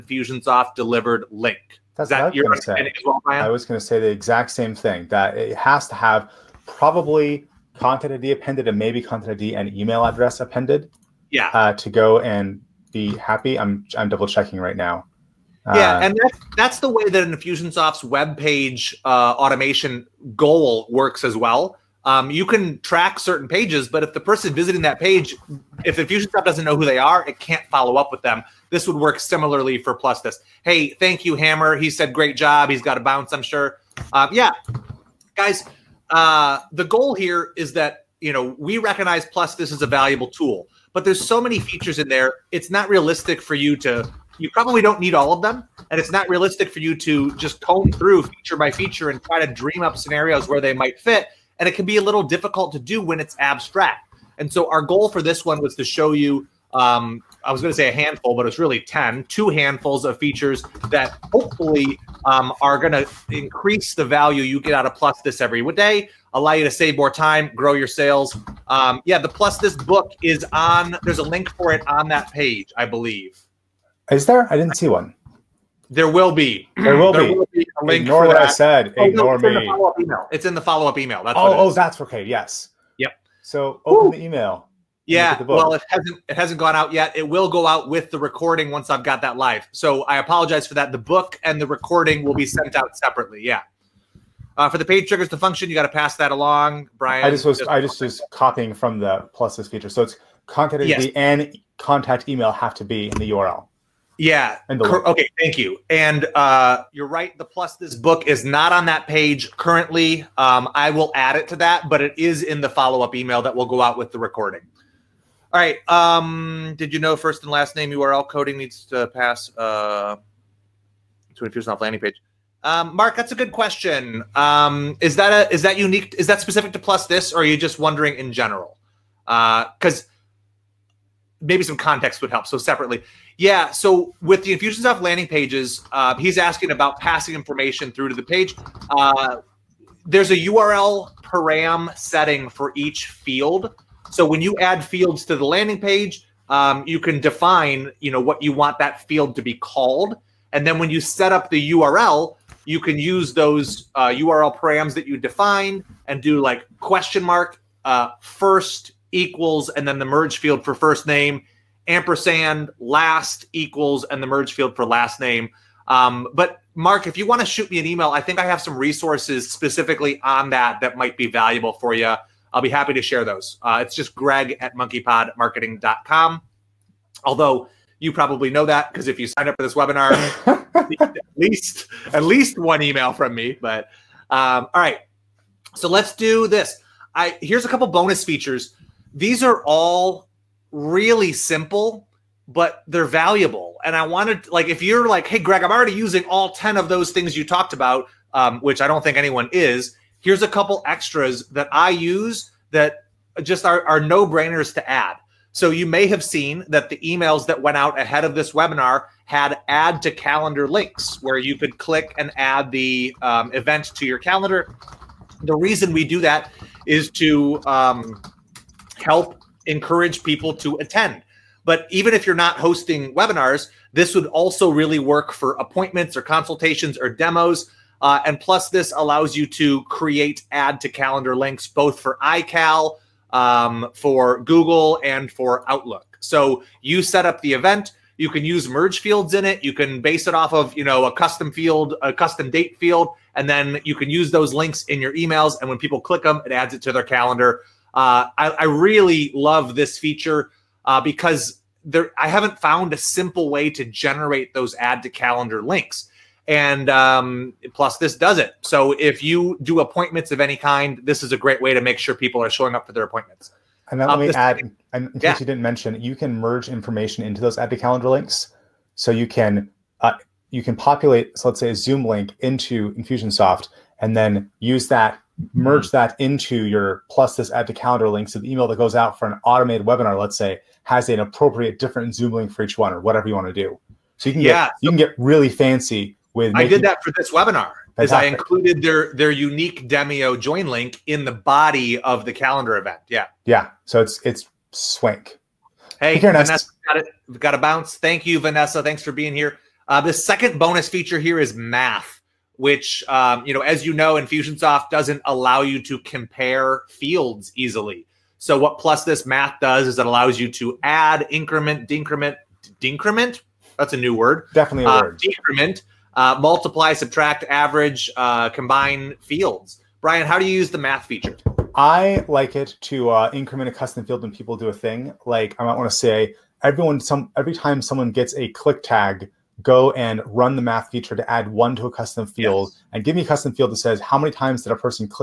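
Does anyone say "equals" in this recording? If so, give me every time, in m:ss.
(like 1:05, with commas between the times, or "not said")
2:39, 2:43.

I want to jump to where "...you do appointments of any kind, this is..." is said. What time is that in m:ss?
4:19.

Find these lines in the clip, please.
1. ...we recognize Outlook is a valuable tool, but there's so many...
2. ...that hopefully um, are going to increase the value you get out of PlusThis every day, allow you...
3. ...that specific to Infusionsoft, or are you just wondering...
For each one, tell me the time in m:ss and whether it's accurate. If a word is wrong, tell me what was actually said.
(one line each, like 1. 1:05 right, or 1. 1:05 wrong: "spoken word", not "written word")
1. 0:38 wrong: "PlusThis", not "Outlook"
2. 1:00 right
3. 2:06 wrong: "PlusThis", not "Infusionsoft".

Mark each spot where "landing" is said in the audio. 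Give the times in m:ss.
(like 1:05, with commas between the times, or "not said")
2:01, 2:14, 2:25.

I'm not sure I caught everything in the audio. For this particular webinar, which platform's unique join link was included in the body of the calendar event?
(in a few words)
Demio.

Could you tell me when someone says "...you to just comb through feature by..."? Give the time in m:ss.
0:46.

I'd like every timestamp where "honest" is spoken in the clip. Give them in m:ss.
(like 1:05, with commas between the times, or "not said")
not said.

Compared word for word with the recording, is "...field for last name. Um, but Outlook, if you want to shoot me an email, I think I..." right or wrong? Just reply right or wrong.
wrong.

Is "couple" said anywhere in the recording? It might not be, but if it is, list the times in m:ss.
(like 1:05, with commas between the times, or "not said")
3:07, 3:20.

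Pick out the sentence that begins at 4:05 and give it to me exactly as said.
And when people click them, it adds it to their calendar.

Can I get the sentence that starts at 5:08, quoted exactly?
So what PlusThis math does is it allows you to add, increment, decrement, decrement.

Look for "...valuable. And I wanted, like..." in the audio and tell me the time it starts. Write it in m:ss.
3:13.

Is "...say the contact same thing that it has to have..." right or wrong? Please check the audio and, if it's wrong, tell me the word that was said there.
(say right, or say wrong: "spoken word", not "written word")
wrong: "exact", not "contact".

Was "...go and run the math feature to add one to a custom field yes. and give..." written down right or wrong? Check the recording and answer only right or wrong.
right.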